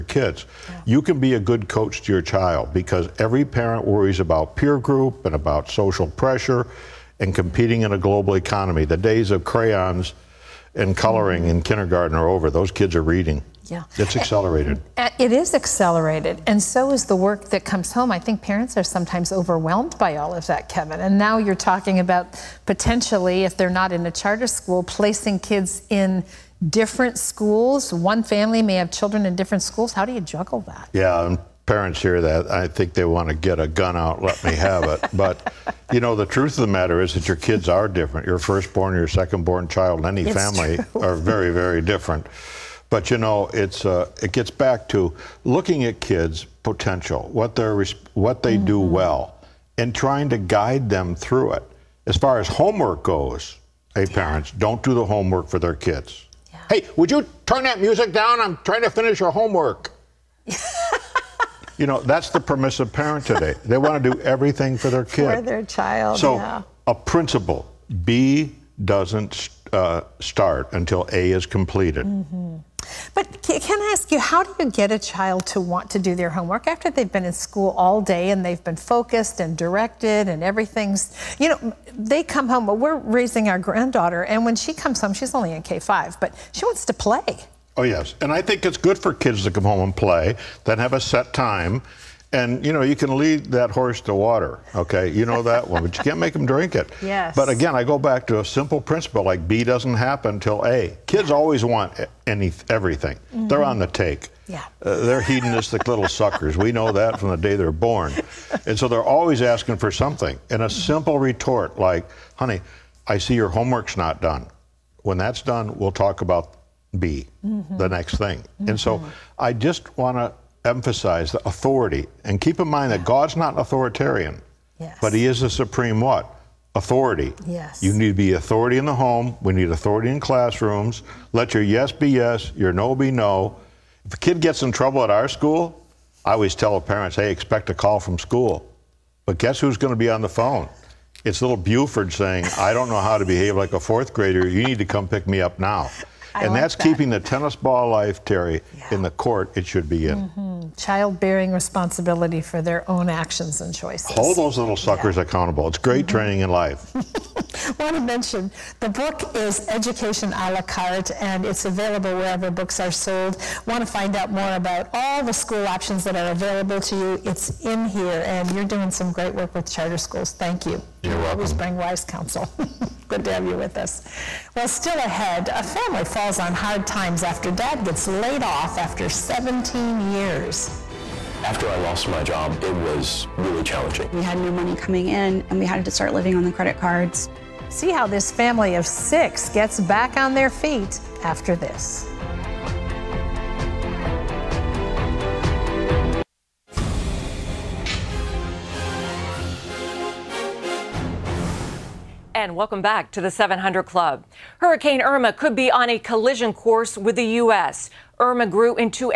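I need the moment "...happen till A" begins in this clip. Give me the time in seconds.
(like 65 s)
99 s.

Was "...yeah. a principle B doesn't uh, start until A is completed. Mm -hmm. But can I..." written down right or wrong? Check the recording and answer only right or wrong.
right.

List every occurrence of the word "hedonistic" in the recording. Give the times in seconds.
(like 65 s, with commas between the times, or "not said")
105 s.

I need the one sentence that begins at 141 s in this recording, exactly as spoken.
It's little Buford saying, I don't know how to behave like a fourth grader.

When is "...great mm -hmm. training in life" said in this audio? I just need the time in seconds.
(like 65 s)
155 s.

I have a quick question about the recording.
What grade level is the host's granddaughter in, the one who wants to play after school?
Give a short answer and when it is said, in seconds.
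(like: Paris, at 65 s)
K5, at 85 s.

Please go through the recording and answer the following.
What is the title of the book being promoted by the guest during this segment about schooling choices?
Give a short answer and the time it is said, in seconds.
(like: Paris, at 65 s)
Education a la carte, at 159 s.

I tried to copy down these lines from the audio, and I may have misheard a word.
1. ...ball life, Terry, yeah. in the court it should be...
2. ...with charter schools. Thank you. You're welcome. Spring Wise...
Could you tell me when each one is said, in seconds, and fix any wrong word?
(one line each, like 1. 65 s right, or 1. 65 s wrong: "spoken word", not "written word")
1. 147 s right
2. 169 s right.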